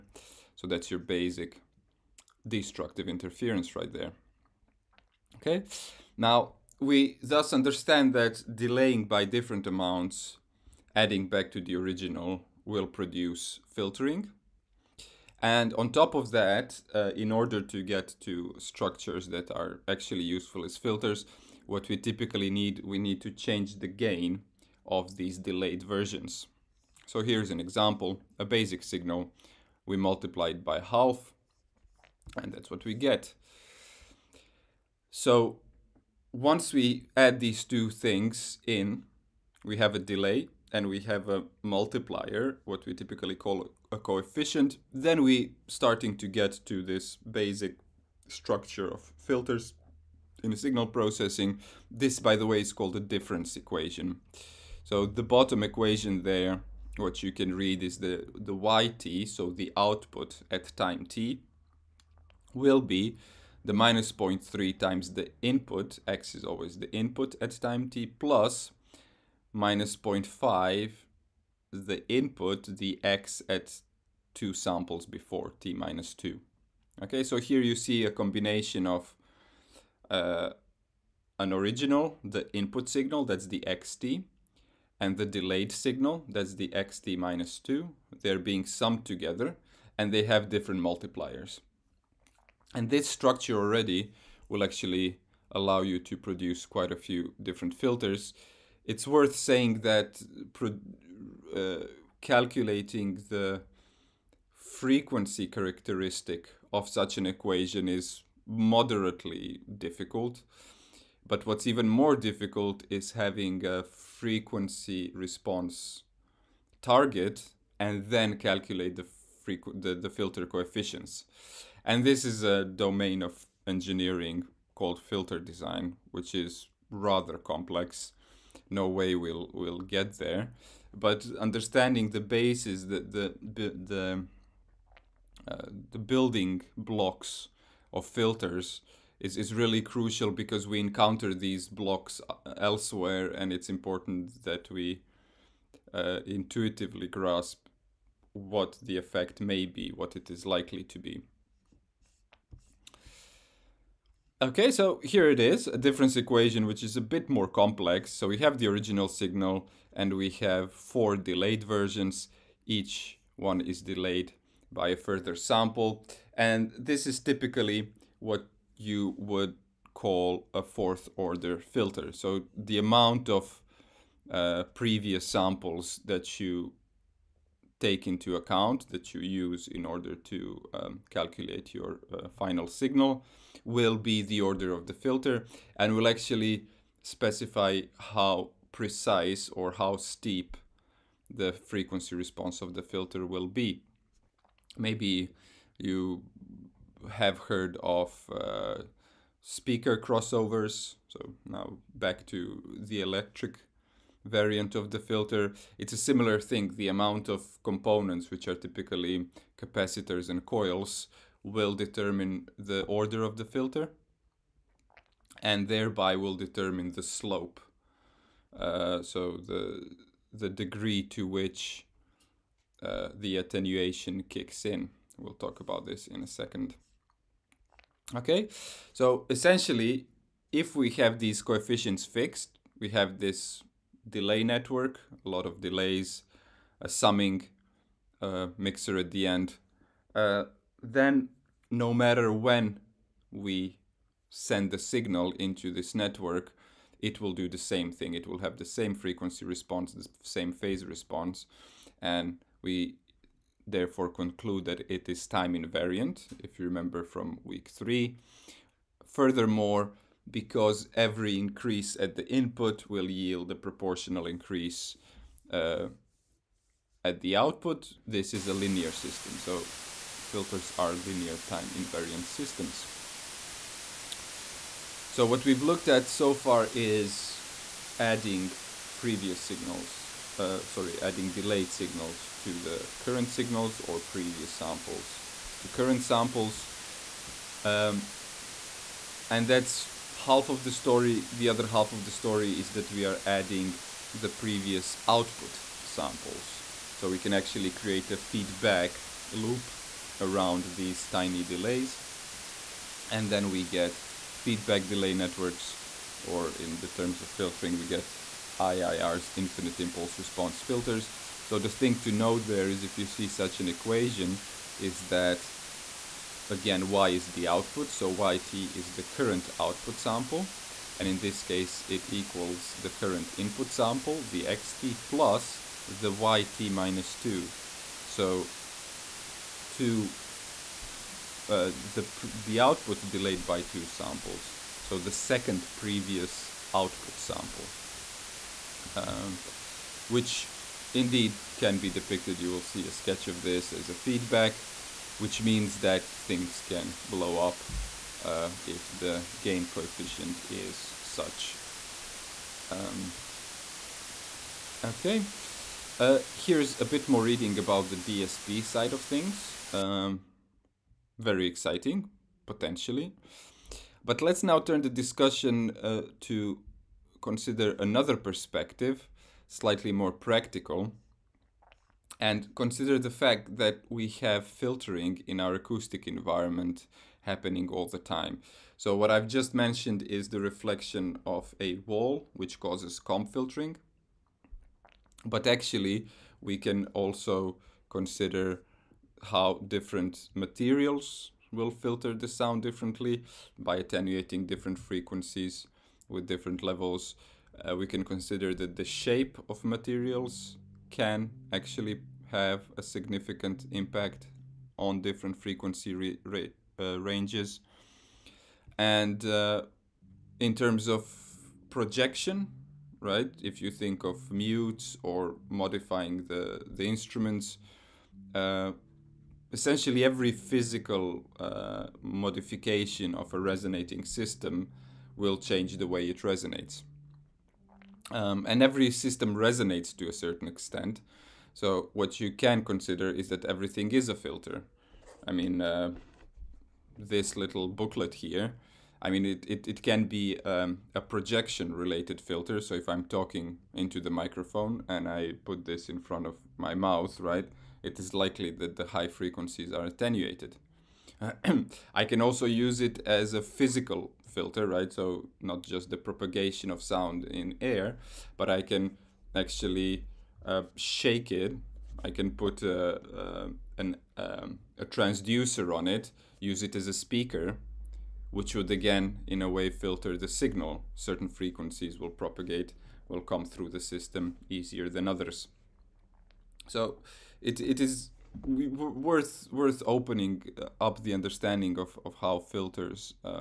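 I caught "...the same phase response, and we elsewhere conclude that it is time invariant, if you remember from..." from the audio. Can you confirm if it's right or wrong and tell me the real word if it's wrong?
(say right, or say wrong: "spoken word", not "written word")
wrong: "therefore", not "elsewhere".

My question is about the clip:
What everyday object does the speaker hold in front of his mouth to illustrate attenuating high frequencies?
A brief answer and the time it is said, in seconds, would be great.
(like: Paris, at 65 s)
booklet, at 437 s.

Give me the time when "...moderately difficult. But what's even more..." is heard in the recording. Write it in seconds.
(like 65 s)
108 s.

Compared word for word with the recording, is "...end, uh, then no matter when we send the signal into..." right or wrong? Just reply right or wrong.
right.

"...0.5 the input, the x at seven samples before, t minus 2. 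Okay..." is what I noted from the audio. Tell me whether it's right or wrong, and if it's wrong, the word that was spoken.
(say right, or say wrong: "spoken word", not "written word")
wrong: "two", not "seven".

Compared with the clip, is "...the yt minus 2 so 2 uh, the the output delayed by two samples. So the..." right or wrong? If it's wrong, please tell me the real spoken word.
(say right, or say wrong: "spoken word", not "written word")
right.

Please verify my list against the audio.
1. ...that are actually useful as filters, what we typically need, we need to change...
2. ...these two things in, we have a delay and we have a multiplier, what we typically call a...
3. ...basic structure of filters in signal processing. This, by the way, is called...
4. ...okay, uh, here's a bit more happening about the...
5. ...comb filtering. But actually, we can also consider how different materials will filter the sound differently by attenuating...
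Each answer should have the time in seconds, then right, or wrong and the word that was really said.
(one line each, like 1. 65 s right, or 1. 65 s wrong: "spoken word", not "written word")
1. 19 s right
2. 37 s right
3. 47 s right
4. 354 s wrong: "reading", not "happening"
5. 382 s right.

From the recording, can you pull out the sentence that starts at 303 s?
And then we get feedback delay networks, or in the terms of filtering, we get IIR's infinite impulse response filters.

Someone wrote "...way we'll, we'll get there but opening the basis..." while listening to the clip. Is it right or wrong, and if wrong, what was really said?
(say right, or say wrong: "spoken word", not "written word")
wrong: "understanding", not "opening".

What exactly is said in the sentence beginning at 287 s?
Um, and that's half of the story.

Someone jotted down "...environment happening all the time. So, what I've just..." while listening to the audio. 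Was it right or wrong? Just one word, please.
right.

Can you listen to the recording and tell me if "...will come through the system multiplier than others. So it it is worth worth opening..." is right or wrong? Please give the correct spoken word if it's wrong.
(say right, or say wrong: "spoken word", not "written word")
wrong: "easier", not "multiplier".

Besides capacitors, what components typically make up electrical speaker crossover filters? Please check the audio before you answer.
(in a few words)
coils.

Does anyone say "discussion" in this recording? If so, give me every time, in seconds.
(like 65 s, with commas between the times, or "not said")
364 s.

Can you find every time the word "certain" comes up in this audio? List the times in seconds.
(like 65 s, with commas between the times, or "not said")
430 s, 470 s.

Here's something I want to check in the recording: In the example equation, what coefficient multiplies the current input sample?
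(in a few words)
-0.3.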